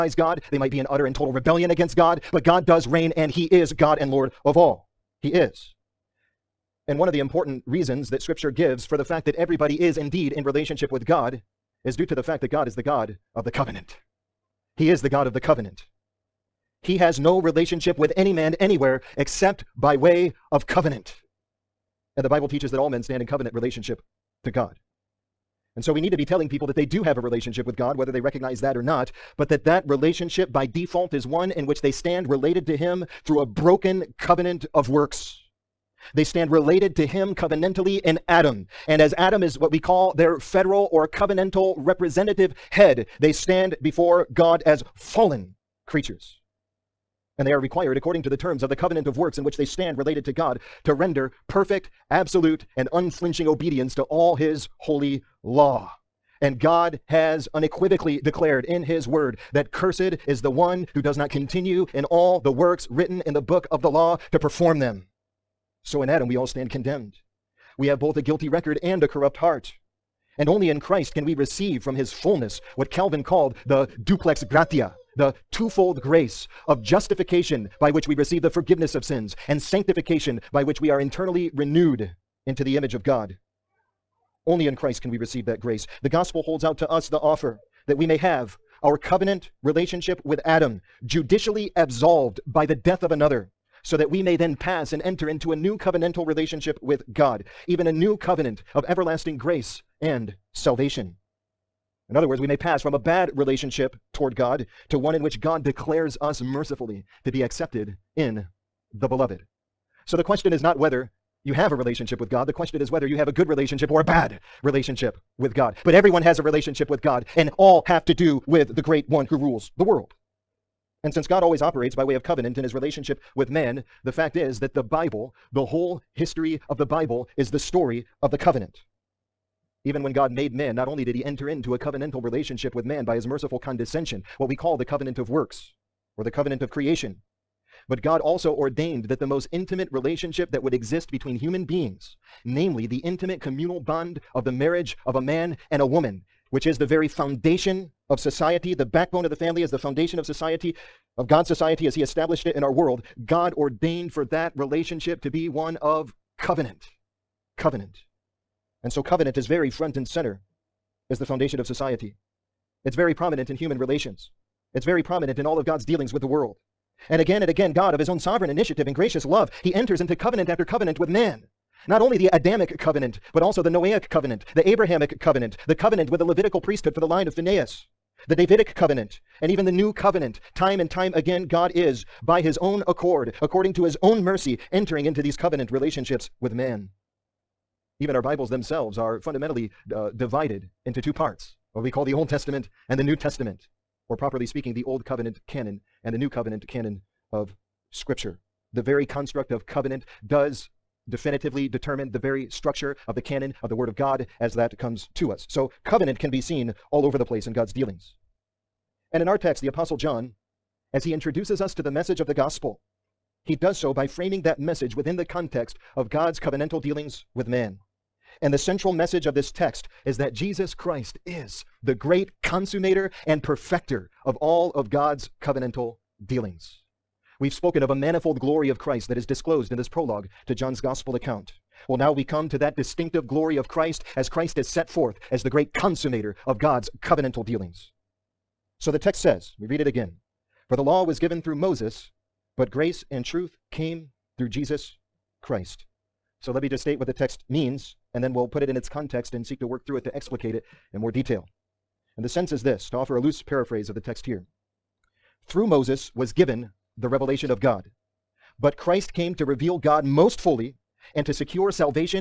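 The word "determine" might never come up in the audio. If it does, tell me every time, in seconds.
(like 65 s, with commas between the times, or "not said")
201 s.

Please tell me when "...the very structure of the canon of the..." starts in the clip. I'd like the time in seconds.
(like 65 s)
202 s.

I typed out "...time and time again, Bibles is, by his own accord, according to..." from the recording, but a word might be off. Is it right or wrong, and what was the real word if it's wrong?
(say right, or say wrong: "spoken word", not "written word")
wrong: "God", not "Bibles".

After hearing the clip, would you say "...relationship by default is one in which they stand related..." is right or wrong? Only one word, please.
right.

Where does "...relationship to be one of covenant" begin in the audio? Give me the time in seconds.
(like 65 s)
154 s.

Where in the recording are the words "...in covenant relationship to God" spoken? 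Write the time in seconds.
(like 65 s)
23 s.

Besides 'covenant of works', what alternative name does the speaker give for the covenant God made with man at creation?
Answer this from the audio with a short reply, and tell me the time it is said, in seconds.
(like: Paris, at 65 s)
covenant of creation, at 136 s.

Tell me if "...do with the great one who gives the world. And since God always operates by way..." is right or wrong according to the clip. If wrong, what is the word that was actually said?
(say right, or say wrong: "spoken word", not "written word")
wrong: "rules", not "gives".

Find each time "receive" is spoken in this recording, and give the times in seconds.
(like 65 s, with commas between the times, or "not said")
71 s, 78 s, 85 s.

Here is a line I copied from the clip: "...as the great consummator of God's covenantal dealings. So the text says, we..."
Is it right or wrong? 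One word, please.
right.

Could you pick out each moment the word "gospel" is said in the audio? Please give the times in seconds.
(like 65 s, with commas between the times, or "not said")
86 s, 212 s, 230 s.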